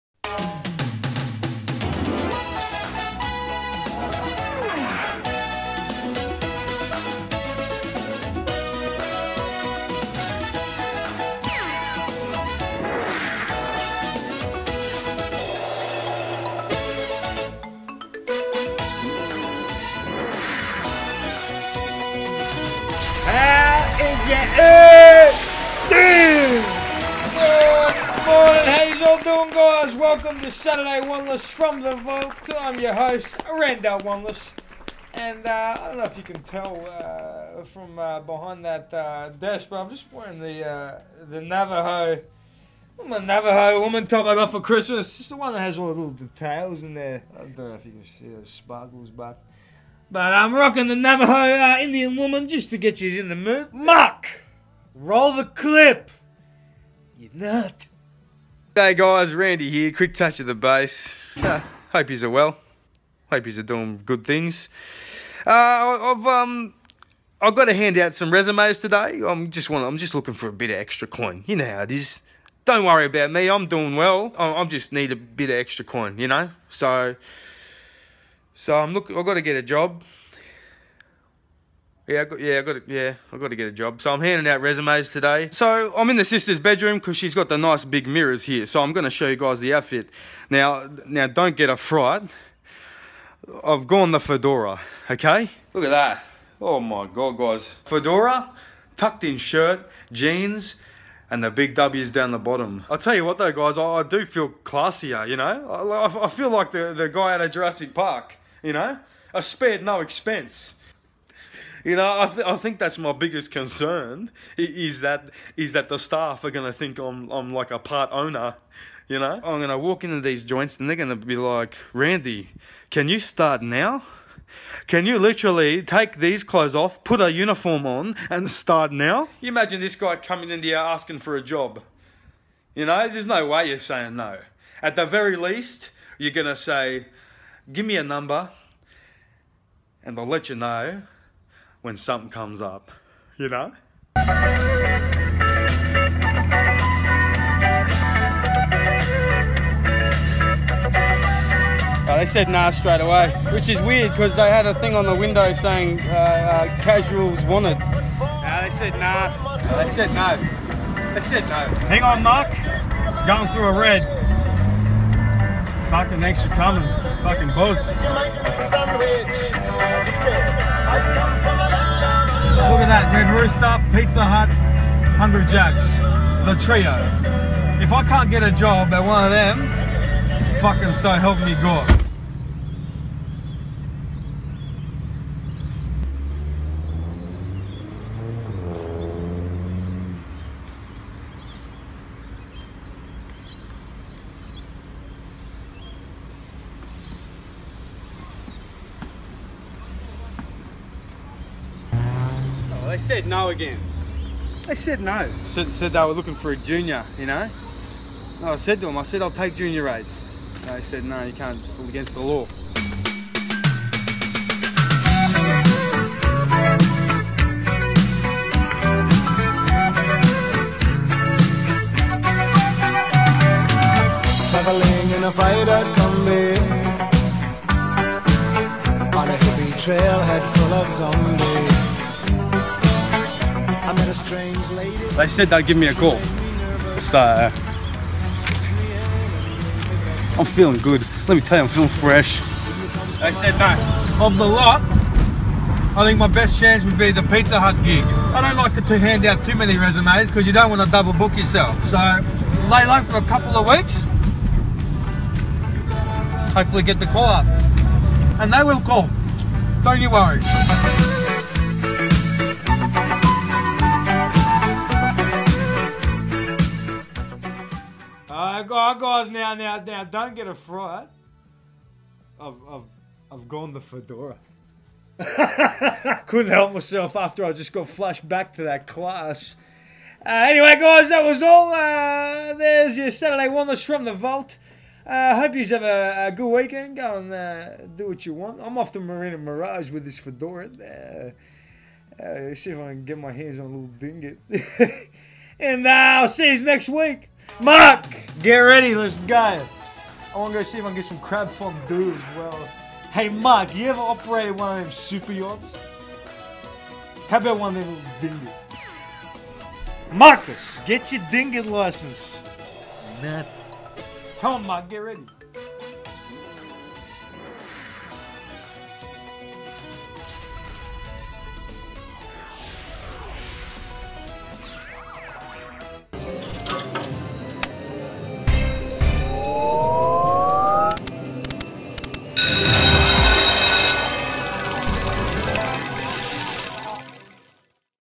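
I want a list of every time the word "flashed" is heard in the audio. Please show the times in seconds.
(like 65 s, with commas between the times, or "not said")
277 s.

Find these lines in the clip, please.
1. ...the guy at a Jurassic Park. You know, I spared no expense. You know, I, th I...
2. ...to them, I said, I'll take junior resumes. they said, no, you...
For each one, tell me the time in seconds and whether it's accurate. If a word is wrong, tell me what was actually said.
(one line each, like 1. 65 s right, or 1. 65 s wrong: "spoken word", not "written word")
1. 106 s right
2. 208 s wrong: "rates", not "resumes".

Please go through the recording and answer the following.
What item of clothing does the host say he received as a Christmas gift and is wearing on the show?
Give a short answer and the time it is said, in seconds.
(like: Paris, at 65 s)
Navajo woman top, at 43 s.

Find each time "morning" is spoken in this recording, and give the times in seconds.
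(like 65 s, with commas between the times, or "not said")
28 s.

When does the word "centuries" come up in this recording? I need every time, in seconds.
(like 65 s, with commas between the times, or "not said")
not said.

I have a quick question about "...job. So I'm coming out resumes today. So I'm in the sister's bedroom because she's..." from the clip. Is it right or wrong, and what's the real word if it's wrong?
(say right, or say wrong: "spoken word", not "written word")
wrong: "handing", not "coming".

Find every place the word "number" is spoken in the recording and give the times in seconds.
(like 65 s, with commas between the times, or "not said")
138 s.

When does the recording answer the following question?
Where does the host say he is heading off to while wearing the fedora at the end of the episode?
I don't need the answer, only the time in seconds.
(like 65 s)
288 s.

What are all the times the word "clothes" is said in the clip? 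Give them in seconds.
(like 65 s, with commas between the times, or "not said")
126 s.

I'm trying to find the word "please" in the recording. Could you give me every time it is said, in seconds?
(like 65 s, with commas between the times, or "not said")
not said.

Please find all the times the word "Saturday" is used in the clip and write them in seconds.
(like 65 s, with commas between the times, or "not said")
30 s, 283 s.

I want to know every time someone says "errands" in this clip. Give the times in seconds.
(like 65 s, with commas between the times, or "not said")
not said.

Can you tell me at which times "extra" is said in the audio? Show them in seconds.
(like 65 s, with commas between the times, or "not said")
70 s, 75 s.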